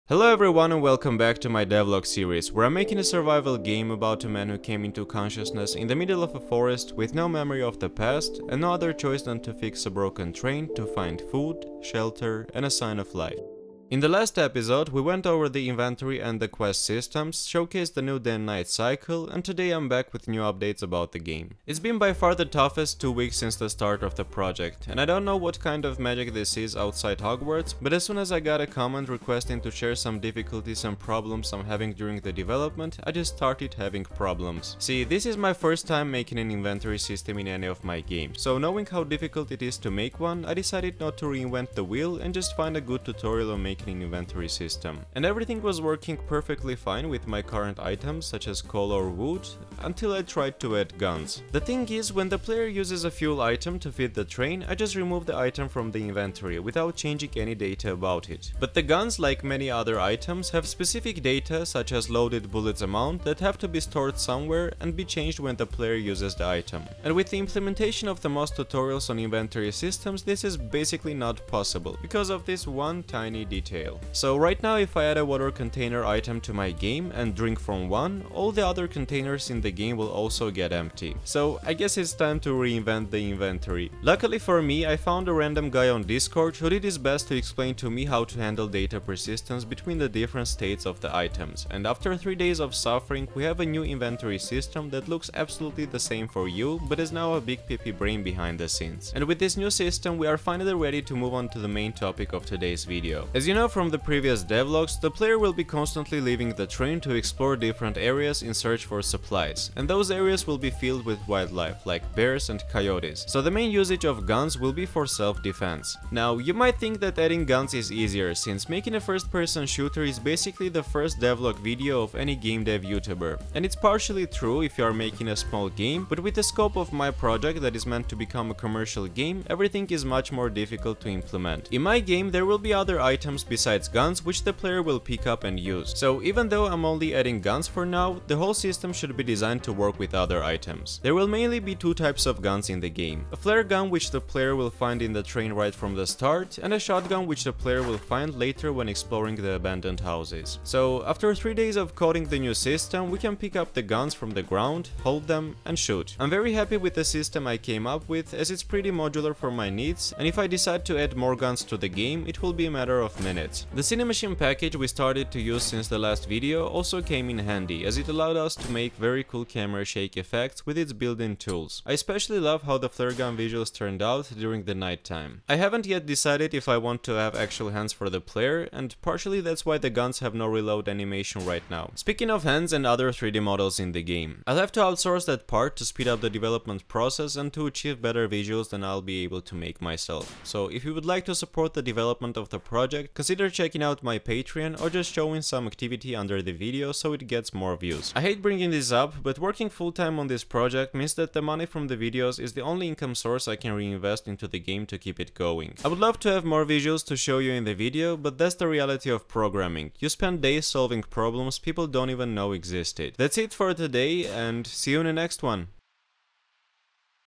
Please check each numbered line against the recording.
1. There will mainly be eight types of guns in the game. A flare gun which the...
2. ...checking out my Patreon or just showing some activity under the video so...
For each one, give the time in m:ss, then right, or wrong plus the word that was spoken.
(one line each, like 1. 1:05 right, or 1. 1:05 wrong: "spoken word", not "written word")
1. 2:21 wrong: "two", not "eight"
2. 3:13 right.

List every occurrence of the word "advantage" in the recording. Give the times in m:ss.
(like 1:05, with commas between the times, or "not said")
not said.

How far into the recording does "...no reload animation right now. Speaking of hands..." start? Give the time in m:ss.
3:00.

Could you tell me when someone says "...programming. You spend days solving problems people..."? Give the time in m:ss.
3:29.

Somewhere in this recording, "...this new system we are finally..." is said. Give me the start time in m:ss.
1:39.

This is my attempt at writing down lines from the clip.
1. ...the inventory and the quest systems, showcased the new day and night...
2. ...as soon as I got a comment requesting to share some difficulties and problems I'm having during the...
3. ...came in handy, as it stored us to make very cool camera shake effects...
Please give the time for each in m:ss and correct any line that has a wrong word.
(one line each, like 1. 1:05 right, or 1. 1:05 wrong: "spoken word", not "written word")
1. 0:15 right
2. 0:27 right
3. 2:47 wrong: "allowed", not "stored".